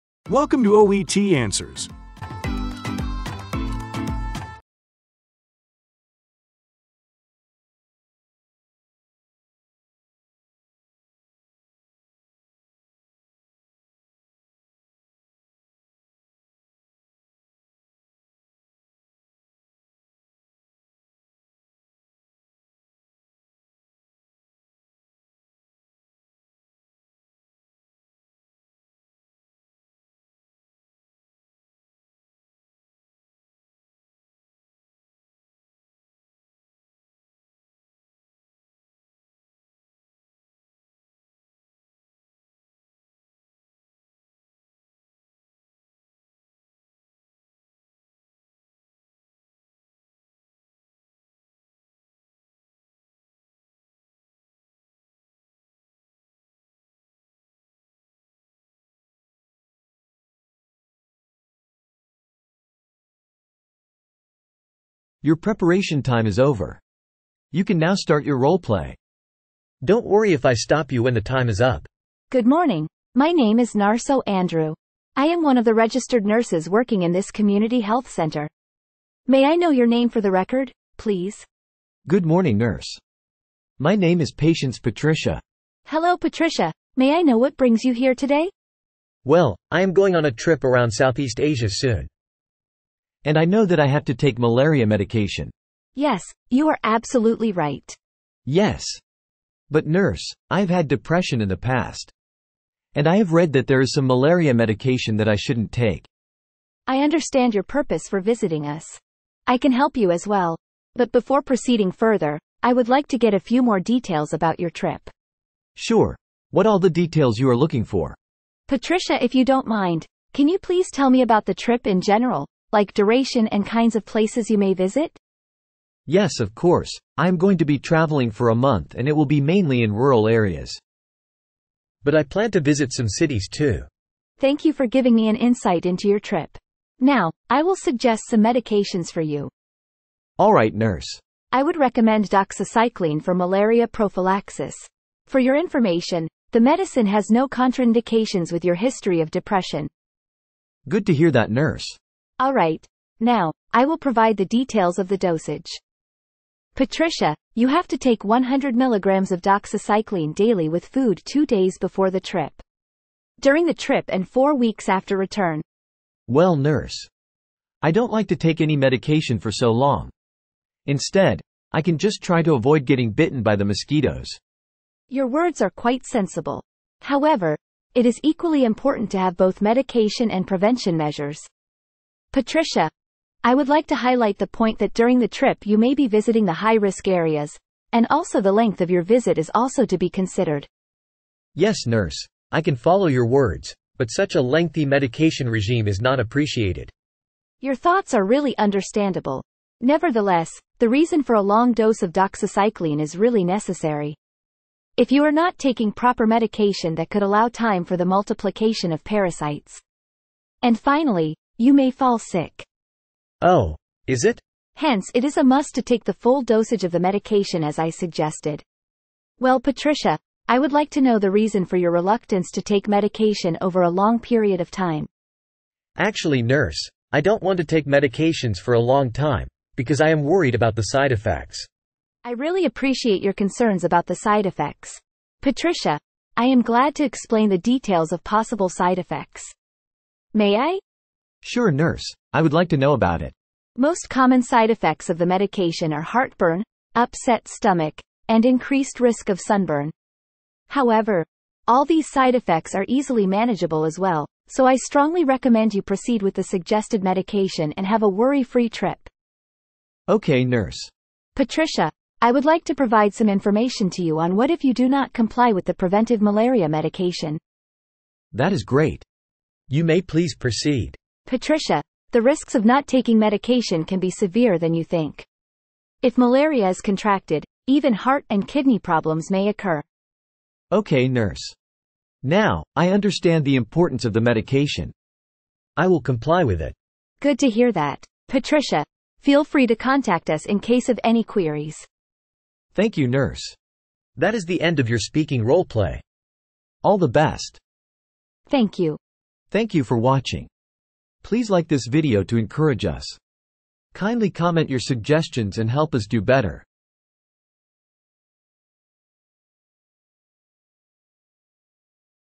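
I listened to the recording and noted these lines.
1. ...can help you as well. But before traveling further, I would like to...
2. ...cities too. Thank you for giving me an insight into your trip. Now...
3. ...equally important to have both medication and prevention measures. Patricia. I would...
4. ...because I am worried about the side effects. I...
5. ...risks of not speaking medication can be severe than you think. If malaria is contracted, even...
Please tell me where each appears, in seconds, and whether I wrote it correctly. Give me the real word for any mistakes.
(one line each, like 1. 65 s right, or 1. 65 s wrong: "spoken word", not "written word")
1. 109 s wrong: "proceeding", not "traveling"
2. 133 s right
3. 178 s right
4. 229 s right
5. 272 s wrong: "taking", not "speaking".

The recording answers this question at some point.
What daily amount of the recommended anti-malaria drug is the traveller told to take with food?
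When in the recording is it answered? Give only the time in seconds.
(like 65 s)
158 s.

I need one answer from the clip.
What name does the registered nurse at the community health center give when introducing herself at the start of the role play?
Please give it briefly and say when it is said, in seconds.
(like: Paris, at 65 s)
Narso Andrew, at 73 s.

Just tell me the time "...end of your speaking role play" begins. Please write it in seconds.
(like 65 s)
294 s.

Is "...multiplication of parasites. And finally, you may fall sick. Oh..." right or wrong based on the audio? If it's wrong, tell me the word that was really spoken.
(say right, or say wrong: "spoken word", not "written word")
right.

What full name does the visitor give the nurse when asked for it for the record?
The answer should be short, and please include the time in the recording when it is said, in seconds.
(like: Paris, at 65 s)
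Patience Patricia, at 84 s.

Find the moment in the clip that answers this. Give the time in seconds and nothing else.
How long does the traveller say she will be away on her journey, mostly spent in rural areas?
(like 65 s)
128 s.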